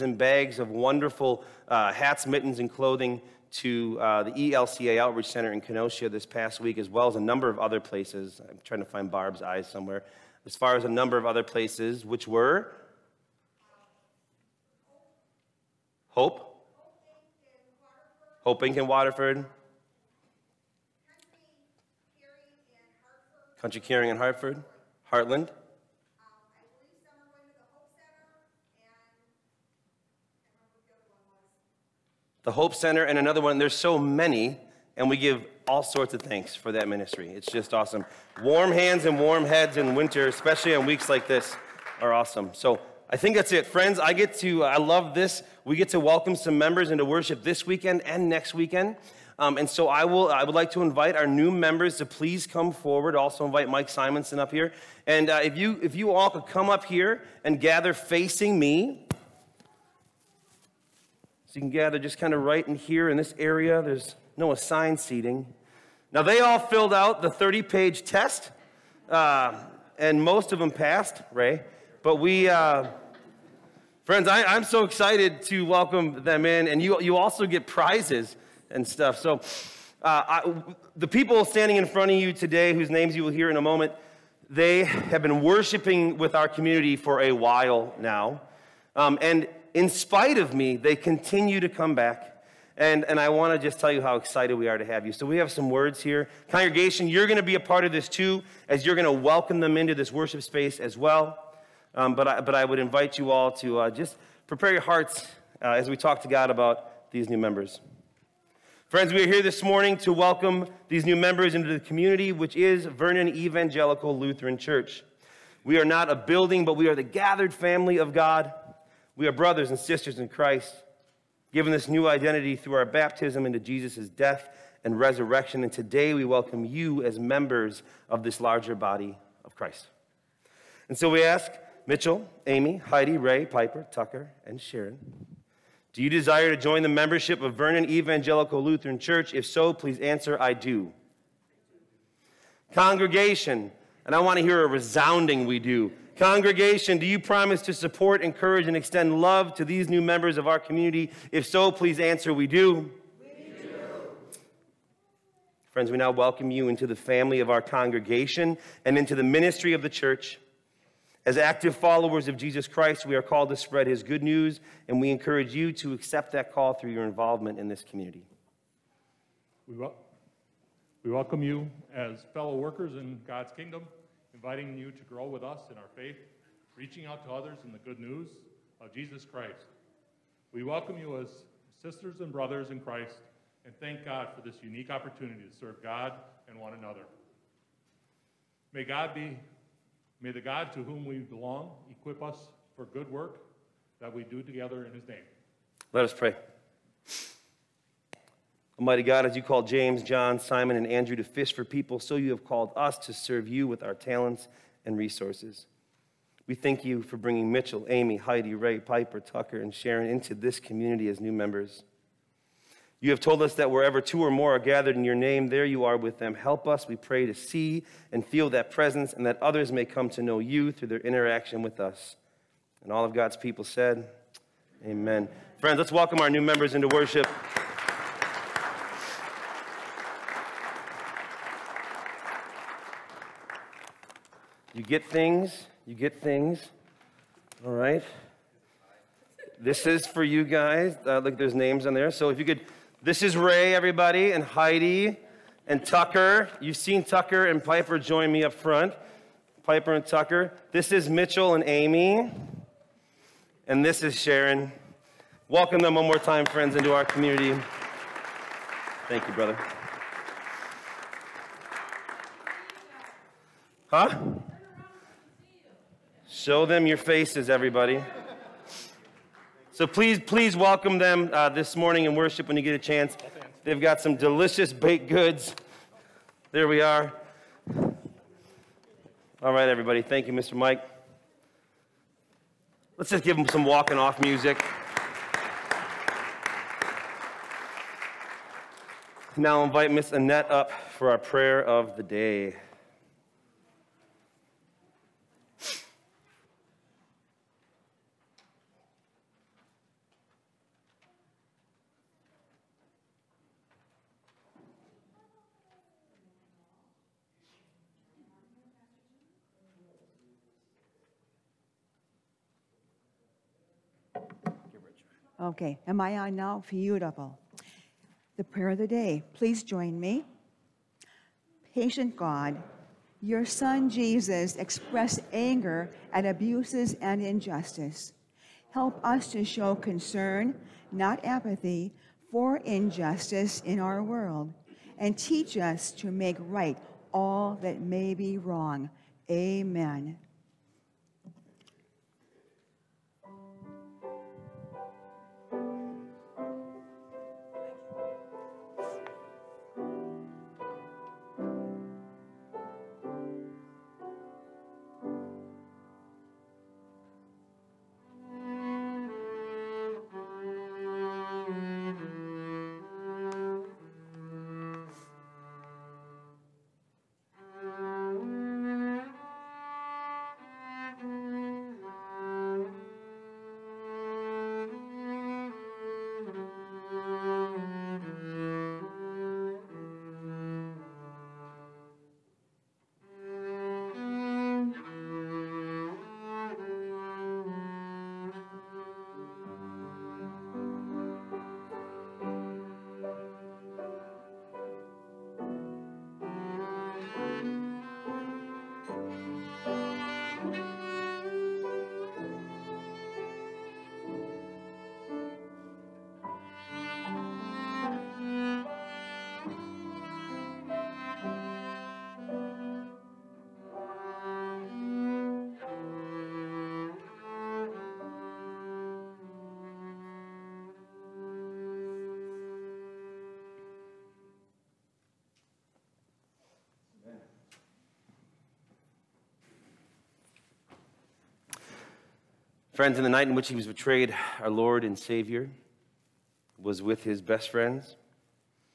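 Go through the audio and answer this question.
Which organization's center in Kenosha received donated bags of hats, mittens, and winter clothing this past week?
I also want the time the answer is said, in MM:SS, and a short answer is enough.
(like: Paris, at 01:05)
ELCA Outreach Center, at 00:04.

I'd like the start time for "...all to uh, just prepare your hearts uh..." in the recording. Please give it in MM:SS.
01:43.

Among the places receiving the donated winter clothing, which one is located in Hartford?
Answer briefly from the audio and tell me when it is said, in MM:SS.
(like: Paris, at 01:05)
Country Caring, at 00:23.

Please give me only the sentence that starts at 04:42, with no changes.
Let's just give them some walking off music.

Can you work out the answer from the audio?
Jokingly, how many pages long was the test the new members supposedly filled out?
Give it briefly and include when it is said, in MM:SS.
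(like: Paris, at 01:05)
30, at 01:07.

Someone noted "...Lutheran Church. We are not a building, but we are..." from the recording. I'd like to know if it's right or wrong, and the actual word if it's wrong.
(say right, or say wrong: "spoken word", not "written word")
right.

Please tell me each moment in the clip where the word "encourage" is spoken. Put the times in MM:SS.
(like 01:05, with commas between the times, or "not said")
02:28, 02:45.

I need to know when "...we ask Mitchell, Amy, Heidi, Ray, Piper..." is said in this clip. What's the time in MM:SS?
02:11.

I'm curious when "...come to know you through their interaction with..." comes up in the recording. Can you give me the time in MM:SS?
03:39.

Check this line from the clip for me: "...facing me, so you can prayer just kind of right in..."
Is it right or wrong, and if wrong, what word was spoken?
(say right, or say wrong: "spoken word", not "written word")
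wrong: "gather", not "prayer".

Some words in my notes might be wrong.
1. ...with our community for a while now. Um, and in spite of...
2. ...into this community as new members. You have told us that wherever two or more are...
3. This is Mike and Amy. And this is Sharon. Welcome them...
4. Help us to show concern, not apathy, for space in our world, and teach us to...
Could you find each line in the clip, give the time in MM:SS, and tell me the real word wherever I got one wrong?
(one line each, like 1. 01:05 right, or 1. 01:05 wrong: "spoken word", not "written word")
1. 01:26 right
2. 03:30 right
3. 04:10 wrong: "Mitchell", not "Mike"
4. 05:28 wrong: "injustice", not "space".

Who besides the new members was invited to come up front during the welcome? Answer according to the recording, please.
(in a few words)
Mike Simonson.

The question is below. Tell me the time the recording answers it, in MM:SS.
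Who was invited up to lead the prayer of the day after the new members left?
04:49.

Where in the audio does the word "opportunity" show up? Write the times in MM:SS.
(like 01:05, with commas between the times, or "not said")
03:04.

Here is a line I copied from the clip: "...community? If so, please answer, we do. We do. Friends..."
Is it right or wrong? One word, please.
right.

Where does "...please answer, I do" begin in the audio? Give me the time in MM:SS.
02:19.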